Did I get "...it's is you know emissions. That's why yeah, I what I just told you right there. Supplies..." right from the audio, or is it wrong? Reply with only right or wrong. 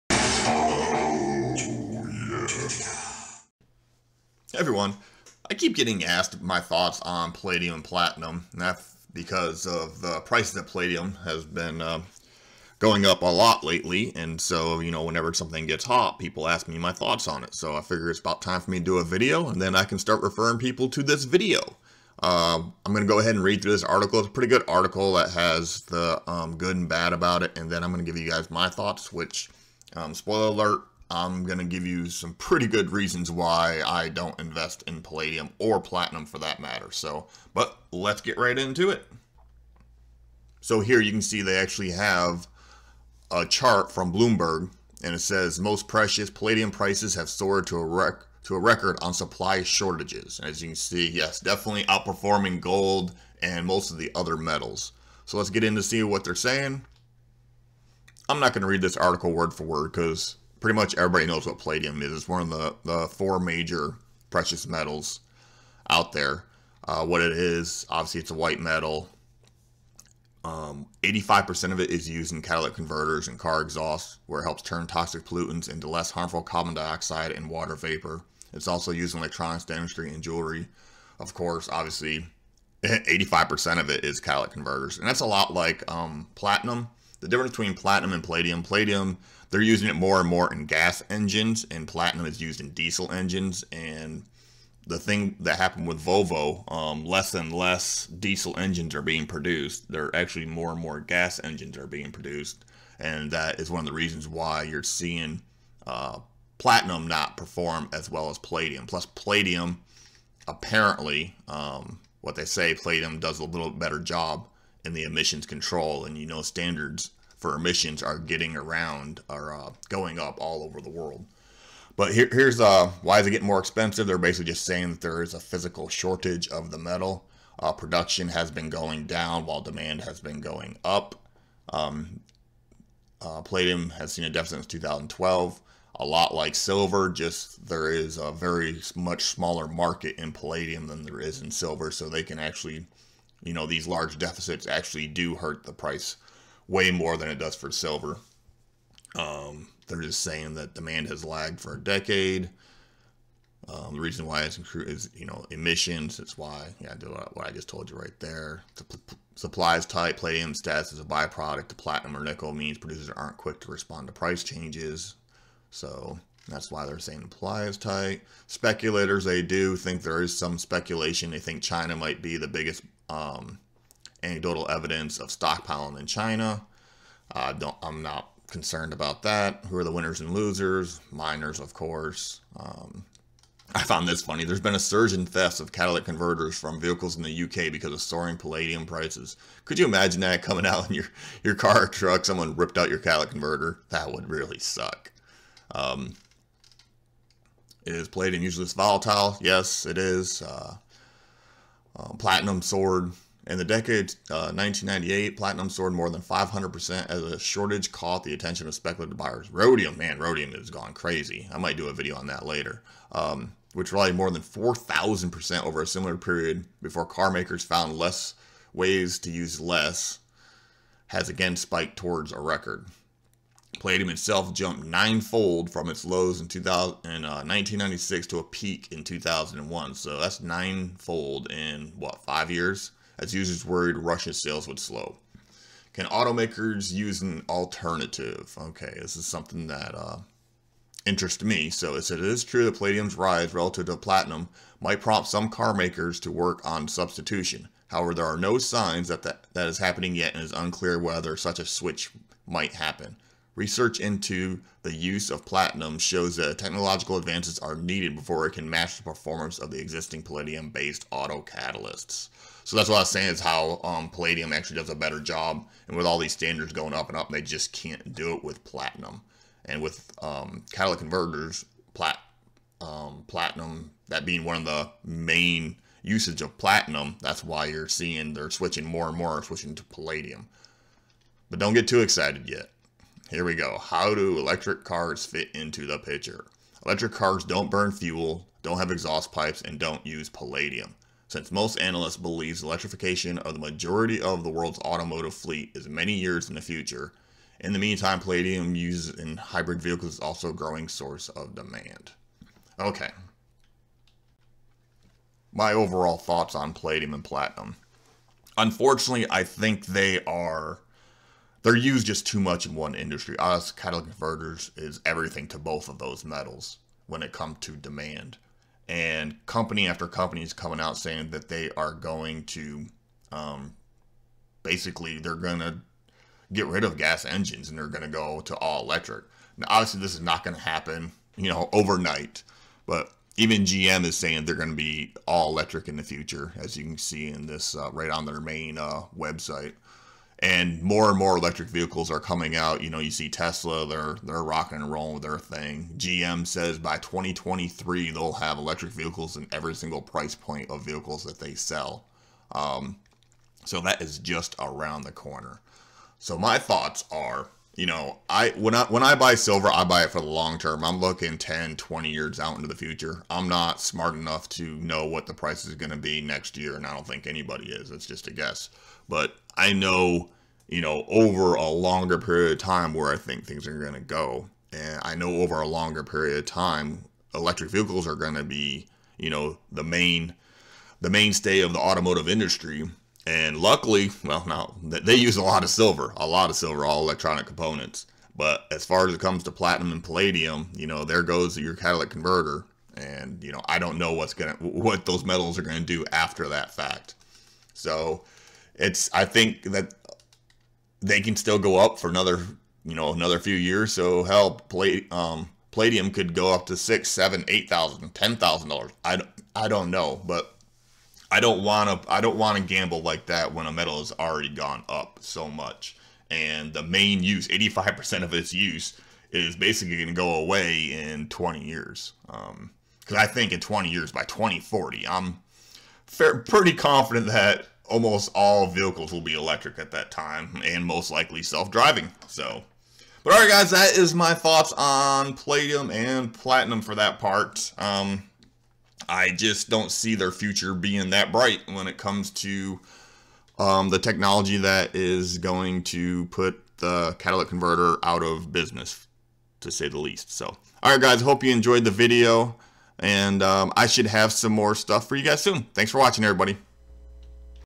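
right.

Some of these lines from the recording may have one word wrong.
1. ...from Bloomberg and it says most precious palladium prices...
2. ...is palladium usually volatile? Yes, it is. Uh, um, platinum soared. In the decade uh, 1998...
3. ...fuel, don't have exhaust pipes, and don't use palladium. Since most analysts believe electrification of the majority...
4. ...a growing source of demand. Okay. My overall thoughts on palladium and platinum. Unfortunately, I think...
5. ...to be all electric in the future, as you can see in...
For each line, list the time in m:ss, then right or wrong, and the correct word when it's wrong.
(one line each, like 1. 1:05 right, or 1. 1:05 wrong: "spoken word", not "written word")
1. 0:43 right
2. 3:17 right
3. 4:47 right
4. 5:00 right
5. 5:34 right.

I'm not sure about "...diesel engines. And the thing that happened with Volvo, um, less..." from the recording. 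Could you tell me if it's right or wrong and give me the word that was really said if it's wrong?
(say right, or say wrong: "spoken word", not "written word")
right.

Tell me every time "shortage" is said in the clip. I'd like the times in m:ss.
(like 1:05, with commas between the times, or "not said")
0:49, 2:05, 3:27.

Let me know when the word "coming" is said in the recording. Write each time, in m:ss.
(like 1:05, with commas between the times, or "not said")
3:10, 5:20, 5:42.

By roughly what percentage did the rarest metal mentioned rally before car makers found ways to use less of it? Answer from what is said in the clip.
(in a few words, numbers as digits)
4,000%.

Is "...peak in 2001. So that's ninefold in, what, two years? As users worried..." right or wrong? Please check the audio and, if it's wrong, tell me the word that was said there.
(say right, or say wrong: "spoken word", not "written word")
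wrong: "five", not "two".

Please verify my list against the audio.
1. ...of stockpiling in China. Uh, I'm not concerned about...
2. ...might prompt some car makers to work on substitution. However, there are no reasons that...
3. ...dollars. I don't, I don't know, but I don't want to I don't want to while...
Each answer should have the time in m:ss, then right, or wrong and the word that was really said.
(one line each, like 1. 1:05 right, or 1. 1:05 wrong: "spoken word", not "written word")
1. 2:55 right
2. 4:04 wrong: "signs", not "reasons"
3. 6:48 wrong: "gamble", not "while".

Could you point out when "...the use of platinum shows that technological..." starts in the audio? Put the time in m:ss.
4:14.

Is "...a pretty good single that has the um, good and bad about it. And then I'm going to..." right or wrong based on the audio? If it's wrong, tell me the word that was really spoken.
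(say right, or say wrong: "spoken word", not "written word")
wrong: "article", not "single".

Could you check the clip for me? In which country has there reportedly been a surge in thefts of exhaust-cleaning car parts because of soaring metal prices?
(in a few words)
UK.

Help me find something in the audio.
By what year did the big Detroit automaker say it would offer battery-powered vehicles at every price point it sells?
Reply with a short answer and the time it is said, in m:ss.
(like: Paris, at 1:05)
2023, at 5:46.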